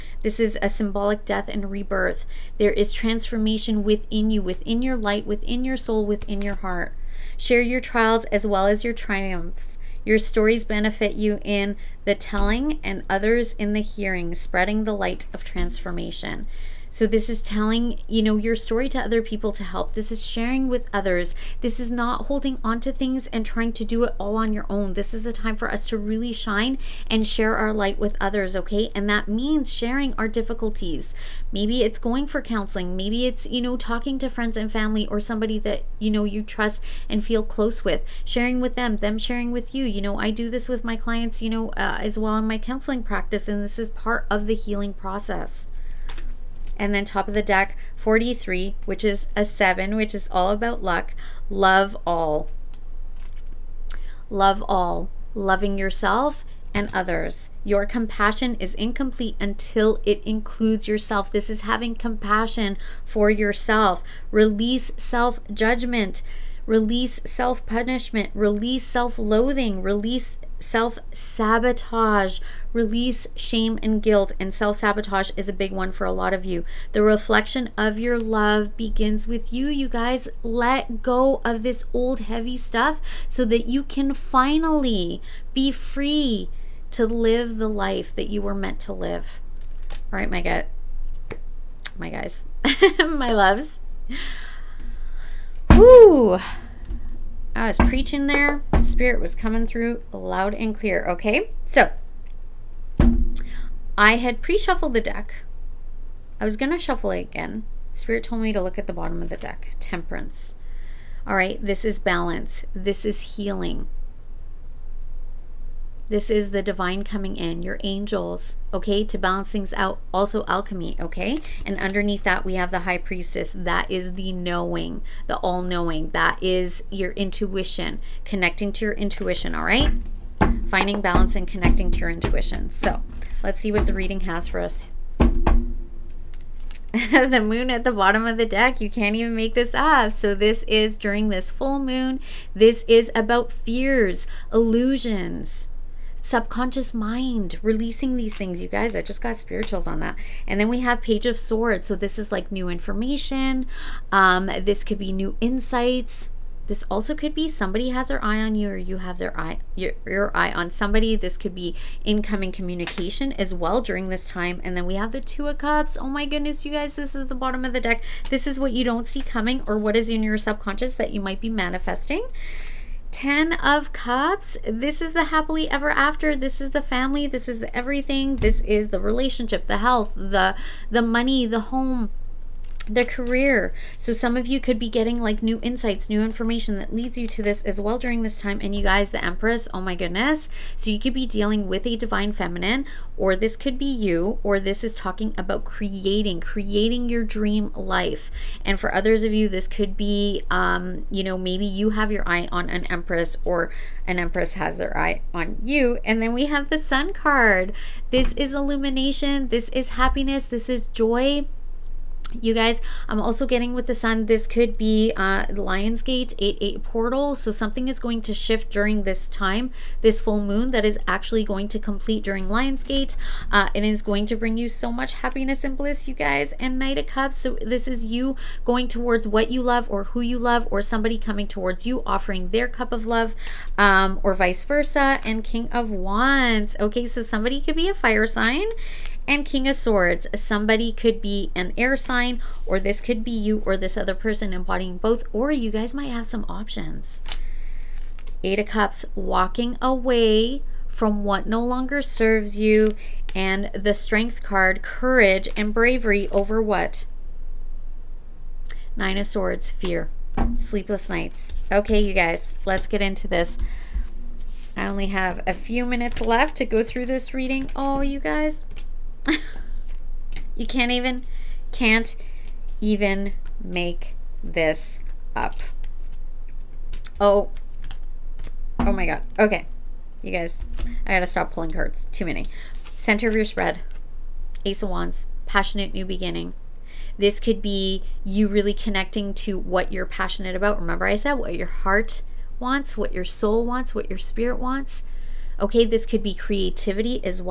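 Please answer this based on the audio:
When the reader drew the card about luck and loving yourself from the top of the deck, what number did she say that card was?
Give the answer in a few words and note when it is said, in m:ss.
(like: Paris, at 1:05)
43, at 0:47.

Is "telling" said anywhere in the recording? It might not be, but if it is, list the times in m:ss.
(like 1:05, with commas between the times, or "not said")
0:12, 0:17.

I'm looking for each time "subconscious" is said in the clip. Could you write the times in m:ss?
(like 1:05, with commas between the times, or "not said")
2:26, 2:50.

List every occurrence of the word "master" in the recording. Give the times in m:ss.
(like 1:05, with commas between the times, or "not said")
not said.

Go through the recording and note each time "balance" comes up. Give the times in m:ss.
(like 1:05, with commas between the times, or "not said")
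1:51, 1:59, 2:11.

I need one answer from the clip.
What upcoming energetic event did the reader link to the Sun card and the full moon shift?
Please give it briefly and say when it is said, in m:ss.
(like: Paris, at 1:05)
Lionsgate 8/8 portal, at 3:35.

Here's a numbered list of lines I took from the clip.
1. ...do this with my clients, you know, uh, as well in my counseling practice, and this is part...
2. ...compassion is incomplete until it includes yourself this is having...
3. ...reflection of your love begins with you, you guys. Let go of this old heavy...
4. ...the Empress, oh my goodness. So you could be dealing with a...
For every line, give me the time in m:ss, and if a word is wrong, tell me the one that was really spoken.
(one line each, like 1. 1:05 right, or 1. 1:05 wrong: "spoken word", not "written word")
1. 0:40 right
2. 0:57 right
3. 1:17 right
4. 3:09 right.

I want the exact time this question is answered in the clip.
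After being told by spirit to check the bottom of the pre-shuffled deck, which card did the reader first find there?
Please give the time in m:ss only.
1:49.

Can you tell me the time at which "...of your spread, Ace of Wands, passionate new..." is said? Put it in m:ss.
4:43.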